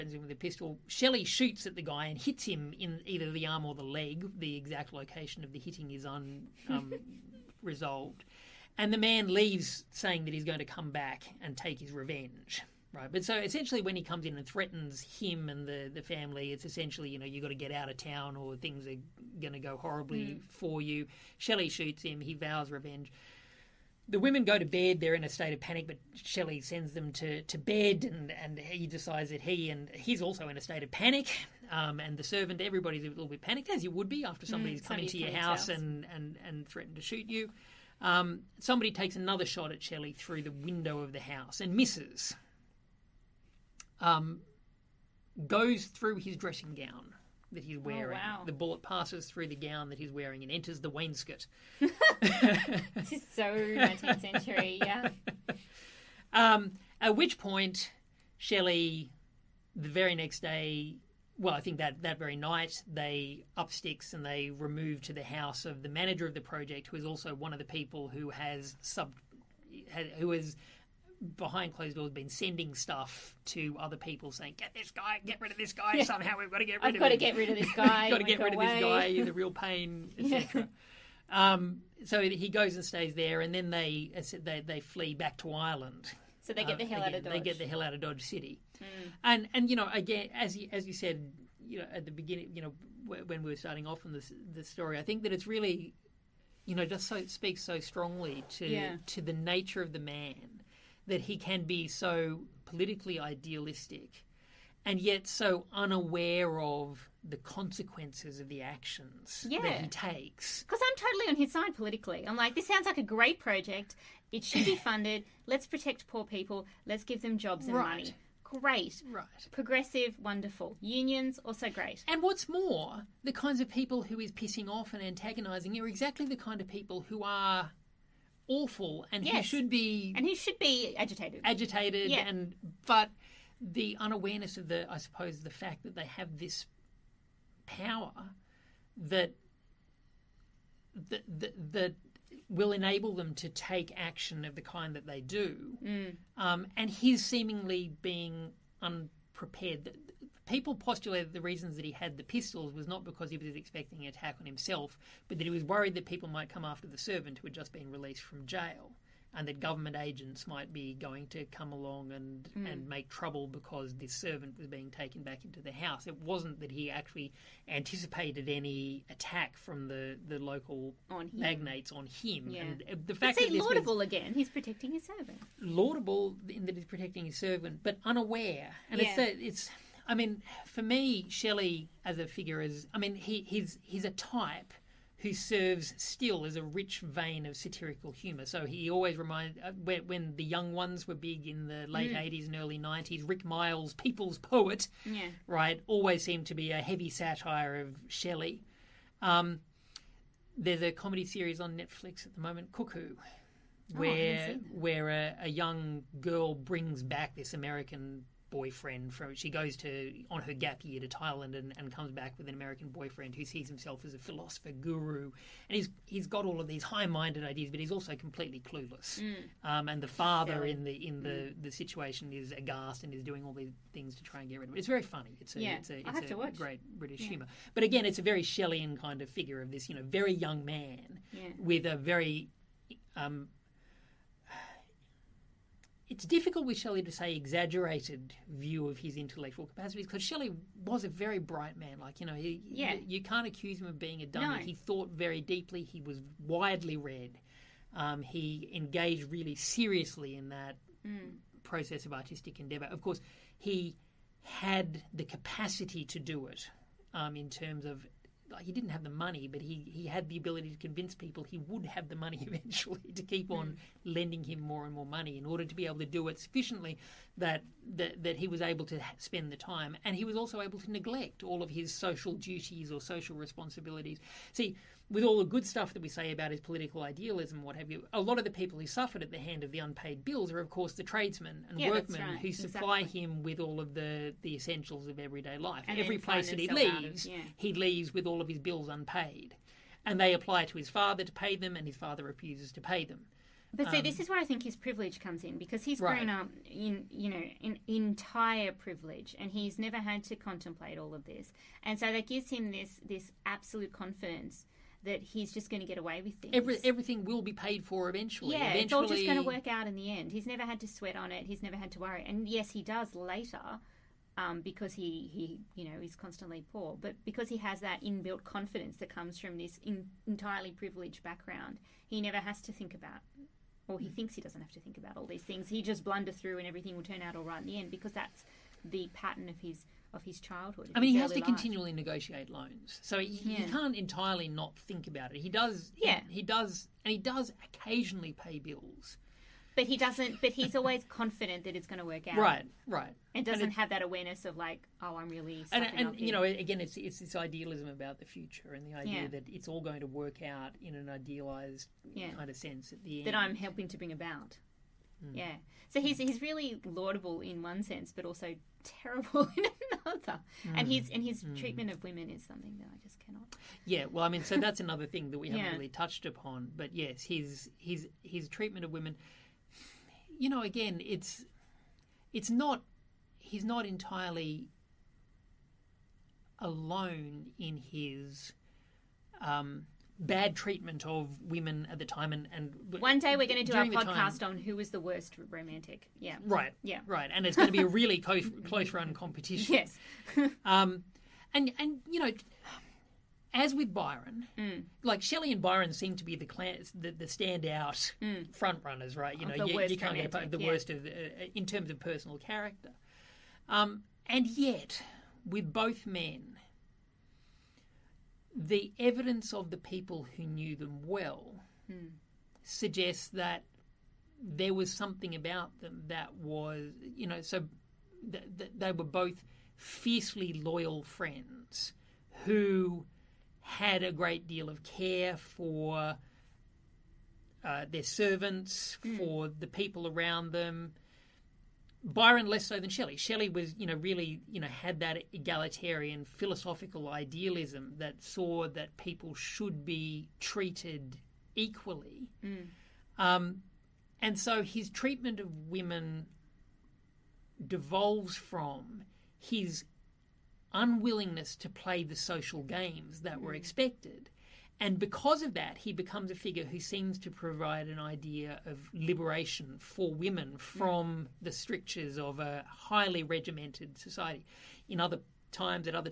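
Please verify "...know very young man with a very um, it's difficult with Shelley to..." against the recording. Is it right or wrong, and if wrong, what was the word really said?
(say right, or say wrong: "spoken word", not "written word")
right.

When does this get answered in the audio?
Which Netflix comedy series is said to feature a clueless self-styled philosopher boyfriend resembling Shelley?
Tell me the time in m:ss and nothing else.
3:22.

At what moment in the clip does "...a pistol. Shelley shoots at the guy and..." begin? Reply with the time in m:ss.
0:00.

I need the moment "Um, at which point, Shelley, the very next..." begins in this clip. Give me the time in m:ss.
0:56.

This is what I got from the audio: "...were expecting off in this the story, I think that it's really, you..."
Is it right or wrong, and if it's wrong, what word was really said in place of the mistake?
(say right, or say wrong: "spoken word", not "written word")
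wrong: "starting", not "expecting".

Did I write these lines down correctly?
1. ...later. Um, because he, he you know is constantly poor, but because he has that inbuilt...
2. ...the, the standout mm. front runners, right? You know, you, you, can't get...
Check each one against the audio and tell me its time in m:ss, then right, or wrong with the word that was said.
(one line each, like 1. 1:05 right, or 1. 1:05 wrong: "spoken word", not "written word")
1. 5:13 right
2. 6:36 right.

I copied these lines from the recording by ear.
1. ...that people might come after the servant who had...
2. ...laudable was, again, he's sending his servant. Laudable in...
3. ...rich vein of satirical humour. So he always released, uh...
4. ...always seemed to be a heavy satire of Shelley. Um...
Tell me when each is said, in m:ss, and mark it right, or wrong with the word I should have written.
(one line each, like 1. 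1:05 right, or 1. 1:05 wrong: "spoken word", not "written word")
1. 2:35 right
2. 2:53 wrong: "protecting", not "sending"
3. 3:06 wrong: "reminded", not "released"
4. 3:15 right.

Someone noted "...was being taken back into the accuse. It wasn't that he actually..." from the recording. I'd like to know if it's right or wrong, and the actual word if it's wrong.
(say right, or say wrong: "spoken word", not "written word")
wrong: "house", not "accuse".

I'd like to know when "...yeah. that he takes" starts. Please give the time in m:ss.
1:49.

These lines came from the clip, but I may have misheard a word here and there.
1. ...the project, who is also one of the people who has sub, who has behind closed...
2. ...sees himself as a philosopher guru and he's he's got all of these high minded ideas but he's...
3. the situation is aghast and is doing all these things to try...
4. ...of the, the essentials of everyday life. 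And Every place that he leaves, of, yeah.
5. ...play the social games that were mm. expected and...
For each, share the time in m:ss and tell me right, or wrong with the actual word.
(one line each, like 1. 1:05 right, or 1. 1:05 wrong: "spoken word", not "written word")
1. 1:06 right
2. 3:33 right
3. 3:41 right
4. 4:43 right
5. 7:31 right.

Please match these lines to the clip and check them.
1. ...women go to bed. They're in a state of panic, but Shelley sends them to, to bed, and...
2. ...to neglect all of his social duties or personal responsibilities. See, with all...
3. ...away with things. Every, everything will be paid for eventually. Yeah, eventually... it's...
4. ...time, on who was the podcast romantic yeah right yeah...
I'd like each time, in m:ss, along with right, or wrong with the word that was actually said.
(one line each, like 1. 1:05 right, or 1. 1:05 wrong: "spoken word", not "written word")
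1. 0:24 right
2. 4:30 wrong: "social", not "personal"
3. 5:05 right
4. 6:24 wrong: "worst", not "podcast".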